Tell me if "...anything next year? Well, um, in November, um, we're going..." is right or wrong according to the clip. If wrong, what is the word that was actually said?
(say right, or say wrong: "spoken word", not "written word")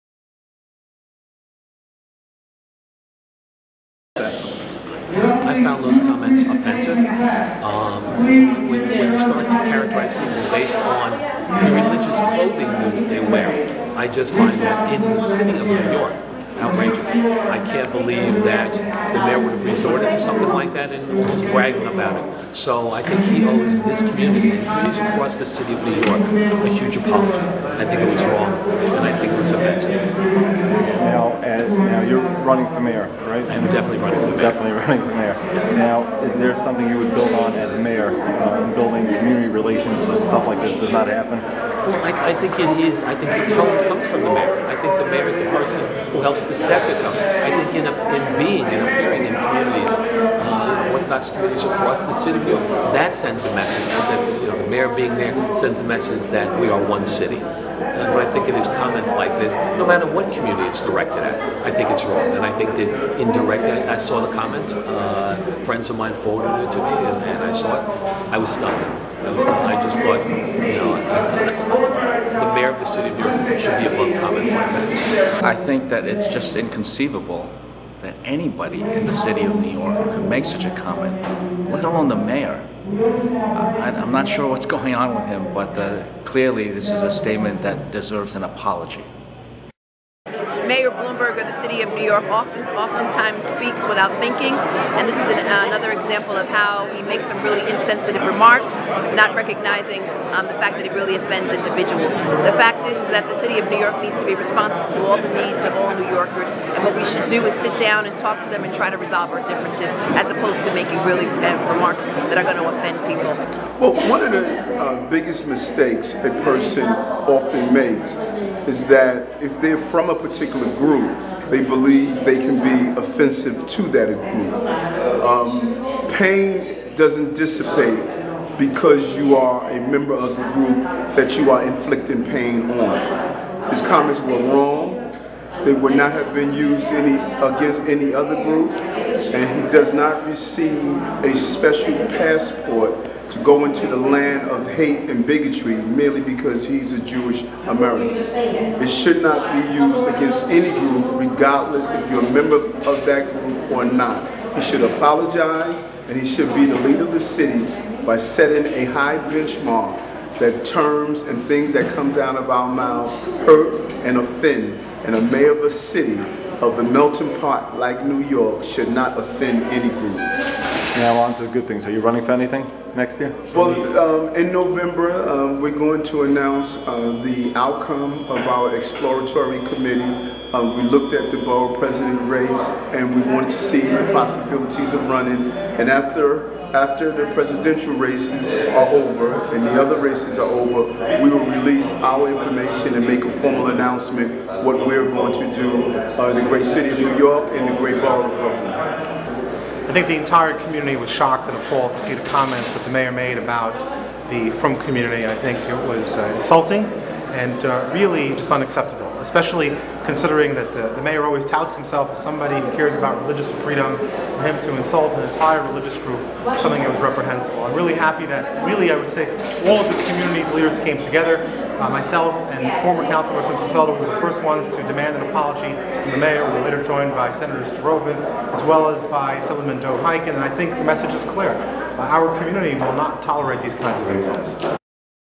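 right.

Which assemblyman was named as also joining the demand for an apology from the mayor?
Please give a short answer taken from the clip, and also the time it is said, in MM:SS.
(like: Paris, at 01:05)
Dov Hikind, at 03:49.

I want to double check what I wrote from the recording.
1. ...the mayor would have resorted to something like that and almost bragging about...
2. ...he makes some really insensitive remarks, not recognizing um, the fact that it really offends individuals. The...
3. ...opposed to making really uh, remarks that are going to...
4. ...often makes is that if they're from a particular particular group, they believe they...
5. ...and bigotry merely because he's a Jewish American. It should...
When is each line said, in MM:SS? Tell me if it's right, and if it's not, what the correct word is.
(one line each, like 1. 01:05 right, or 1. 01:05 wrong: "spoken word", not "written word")
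1. 00:18 right
2. 01:36 right
3. 01:50 right
4. 01:56 right
5. 02:25 right.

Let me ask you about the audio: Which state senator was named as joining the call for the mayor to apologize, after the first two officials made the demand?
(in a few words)
Senator Rovman.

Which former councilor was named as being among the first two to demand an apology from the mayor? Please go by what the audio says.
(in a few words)
Felder.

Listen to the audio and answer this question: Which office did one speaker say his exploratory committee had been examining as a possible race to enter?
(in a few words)
Borough president.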